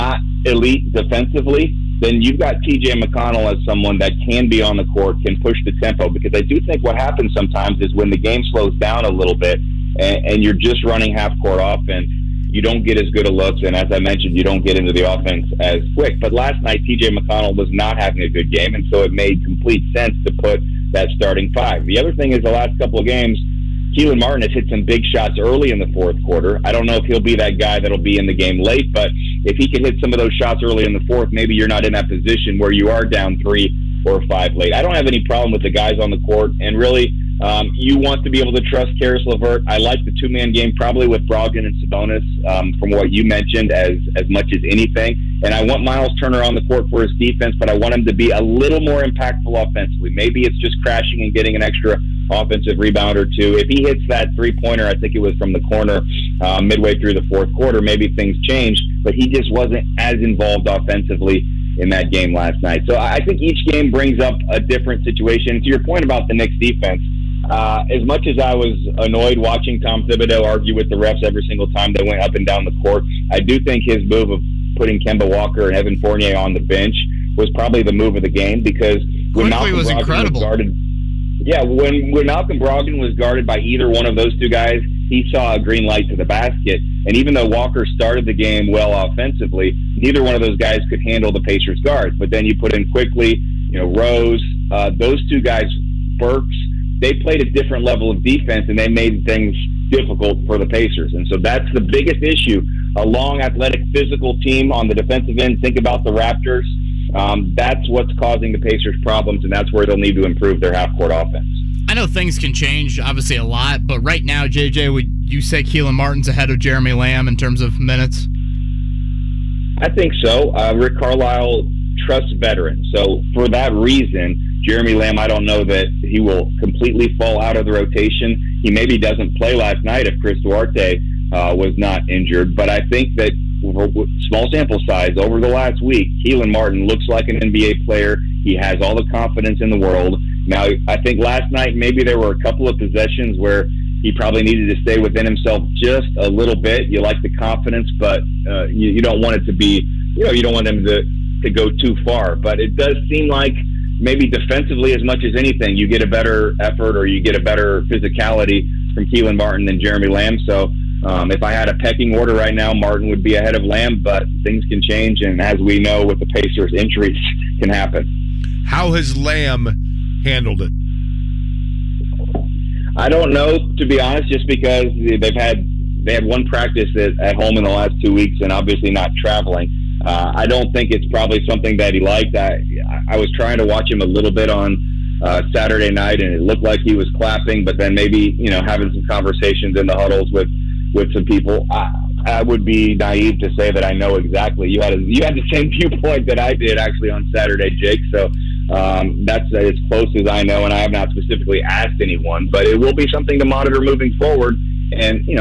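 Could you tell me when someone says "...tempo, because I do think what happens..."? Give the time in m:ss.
0:05.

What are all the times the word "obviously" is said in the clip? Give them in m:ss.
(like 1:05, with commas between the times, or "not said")
1:52, 2:58.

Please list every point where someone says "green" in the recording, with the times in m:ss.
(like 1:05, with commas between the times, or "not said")
1:25.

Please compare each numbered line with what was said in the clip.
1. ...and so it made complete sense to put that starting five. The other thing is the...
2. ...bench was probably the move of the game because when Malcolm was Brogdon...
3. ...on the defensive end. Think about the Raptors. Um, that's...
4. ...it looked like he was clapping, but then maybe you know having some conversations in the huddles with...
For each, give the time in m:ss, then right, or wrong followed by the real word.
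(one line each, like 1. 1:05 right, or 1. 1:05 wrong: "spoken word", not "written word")
1. 0:18 right
2. 1:16 right
3. 1:44 right
4. 3:06 right.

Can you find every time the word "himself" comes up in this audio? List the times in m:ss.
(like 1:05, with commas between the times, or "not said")
2:25.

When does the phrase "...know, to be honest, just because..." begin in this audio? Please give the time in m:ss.
2:53.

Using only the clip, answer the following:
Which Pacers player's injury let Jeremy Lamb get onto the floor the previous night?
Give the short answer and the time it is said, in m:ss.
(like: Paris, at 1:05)
Chris Duarte, at 2:10.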